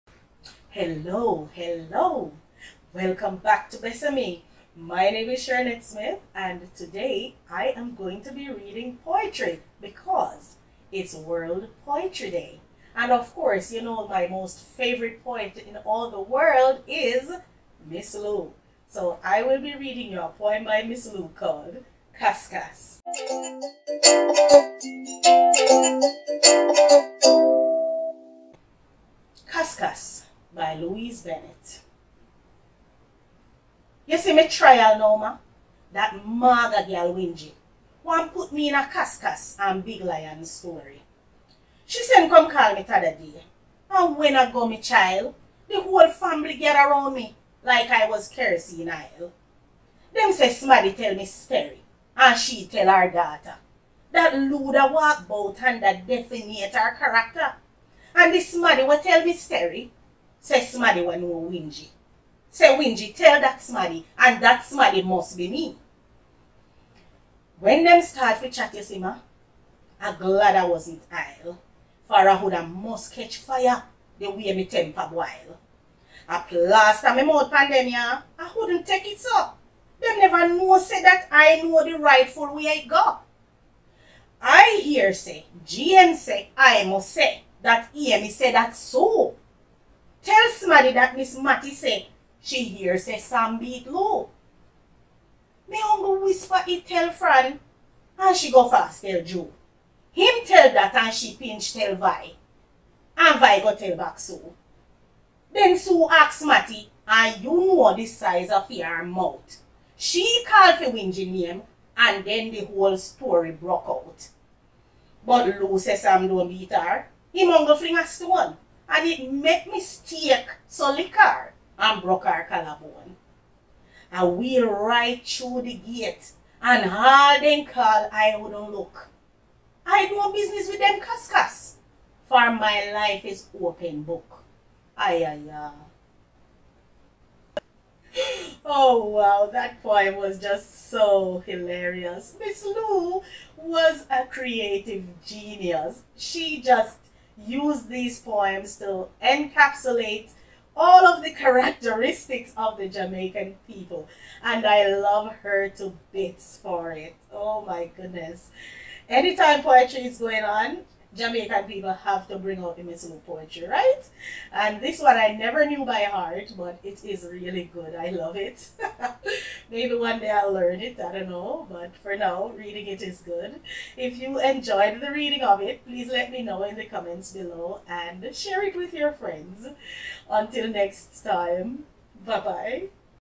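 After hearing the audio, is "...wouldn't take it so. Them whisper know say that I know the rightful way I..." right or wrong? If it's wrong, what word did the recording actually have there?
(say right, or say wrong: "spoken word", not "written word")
wrong: "never", not "whisper".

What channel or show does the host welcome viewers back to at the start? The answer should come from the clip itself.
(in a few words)
Besami.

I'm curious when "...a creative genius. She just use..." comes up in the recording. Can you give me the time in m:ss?
2:24.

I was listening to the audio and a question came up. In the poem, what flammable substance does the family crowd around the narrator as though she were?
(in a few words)
kerosene oil.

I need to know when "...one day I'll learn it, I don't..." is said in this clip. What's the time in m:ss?
2:49.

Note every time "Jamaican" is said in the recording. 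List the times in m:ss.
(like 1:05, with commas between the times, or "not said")
2:32, 2:41.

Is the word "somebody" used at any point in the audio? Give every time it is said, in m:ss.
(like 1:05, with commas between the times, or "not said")
0:50, 1:30.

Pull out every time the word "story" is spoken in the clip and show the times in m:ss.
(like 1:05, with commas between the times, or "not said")
0:40, 0:51, 0:59, 1:52.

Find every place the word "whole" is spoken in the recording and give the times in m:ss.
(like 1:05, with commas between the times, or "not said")
0:45, 1:52.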